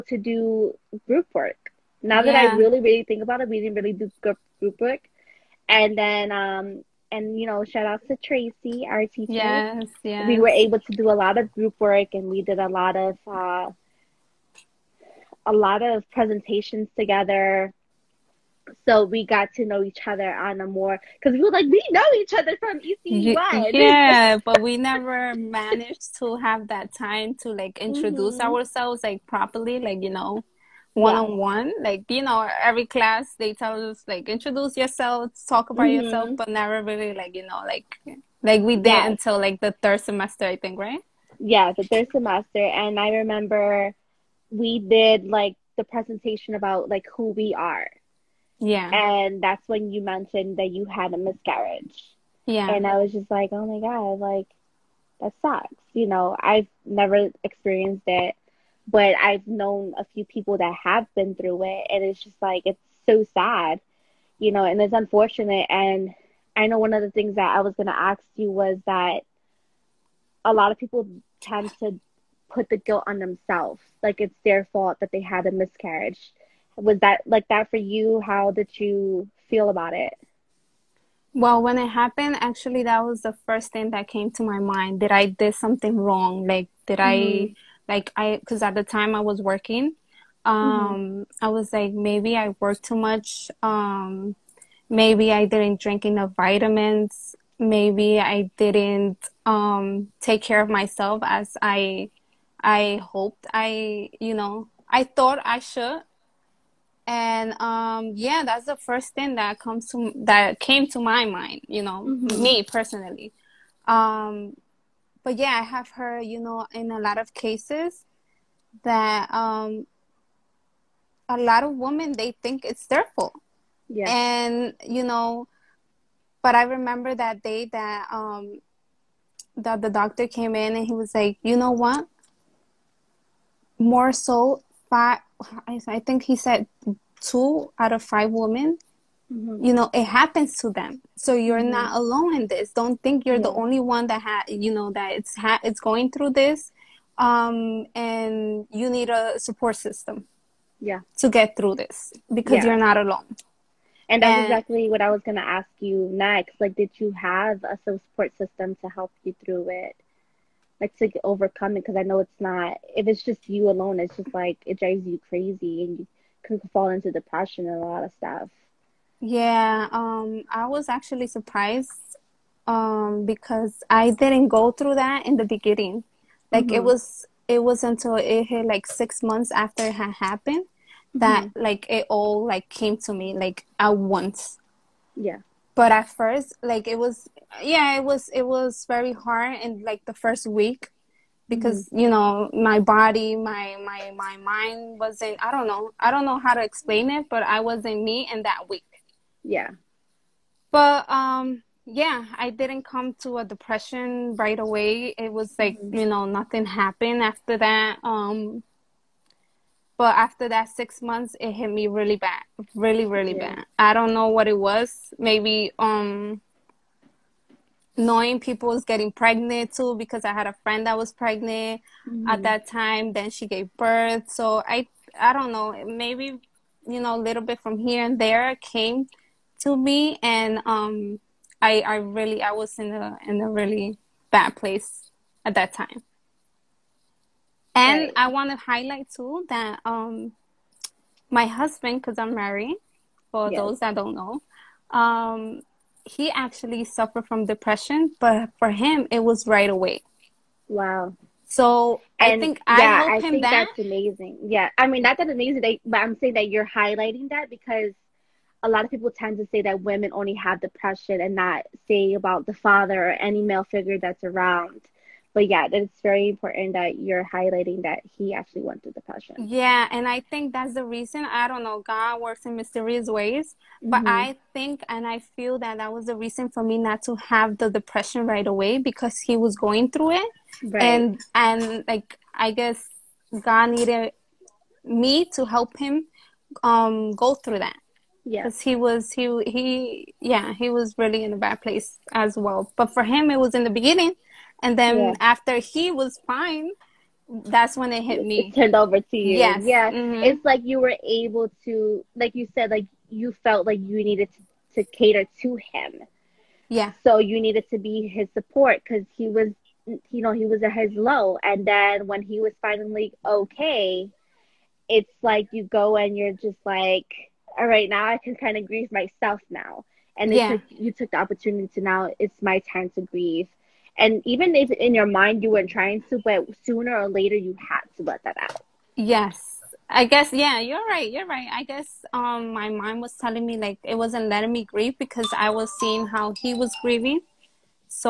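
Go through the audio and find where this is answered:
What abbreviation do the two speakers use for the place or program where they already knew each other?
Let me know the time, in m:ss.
0:22.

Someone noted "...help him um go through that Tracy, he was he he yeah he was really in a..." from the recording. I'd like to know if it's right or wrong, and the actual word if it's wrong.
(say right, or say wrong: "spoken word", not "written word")
wrong: "Yes", not "Tracy".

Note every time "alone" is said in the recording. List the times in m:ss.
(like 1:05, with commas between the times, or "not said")
2:21, 2:32, 2:43.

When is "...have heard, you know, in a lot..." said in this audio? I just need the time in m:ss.
1:55.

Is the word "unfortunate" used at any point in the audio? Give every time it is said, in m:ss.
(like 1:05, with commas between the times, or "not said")
1:04.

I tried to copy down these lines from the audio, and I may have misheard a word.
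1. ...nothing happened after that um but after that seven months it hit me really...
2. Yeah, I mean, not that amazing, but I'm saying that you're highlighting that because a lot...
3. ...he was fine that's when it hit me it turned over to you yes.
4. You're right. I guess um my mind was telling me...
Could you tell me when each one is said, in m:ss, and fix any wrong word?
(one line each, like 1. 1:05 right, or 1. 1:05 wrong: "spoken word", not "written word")
1. 3:26 wrong: "six", not "seven"
2. 4:14 right
3. 4:55 right
4. 5:31 right.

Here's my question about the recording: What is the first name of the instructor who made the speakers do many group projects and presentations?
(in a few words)
Tracy.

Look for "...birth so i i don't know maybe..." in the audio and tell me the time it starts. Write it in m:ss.
3:43.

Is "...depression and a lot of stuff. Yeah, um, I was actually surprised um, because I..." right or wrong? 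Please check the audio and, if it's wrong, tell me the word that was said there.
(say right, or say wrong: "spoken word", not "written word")
right.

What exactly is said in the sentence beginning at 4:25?
But yeah, it's very important that you're highlighting that he actually went through depression.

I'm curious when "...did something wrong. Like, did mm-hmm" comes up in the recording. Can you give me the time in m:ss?
1:25.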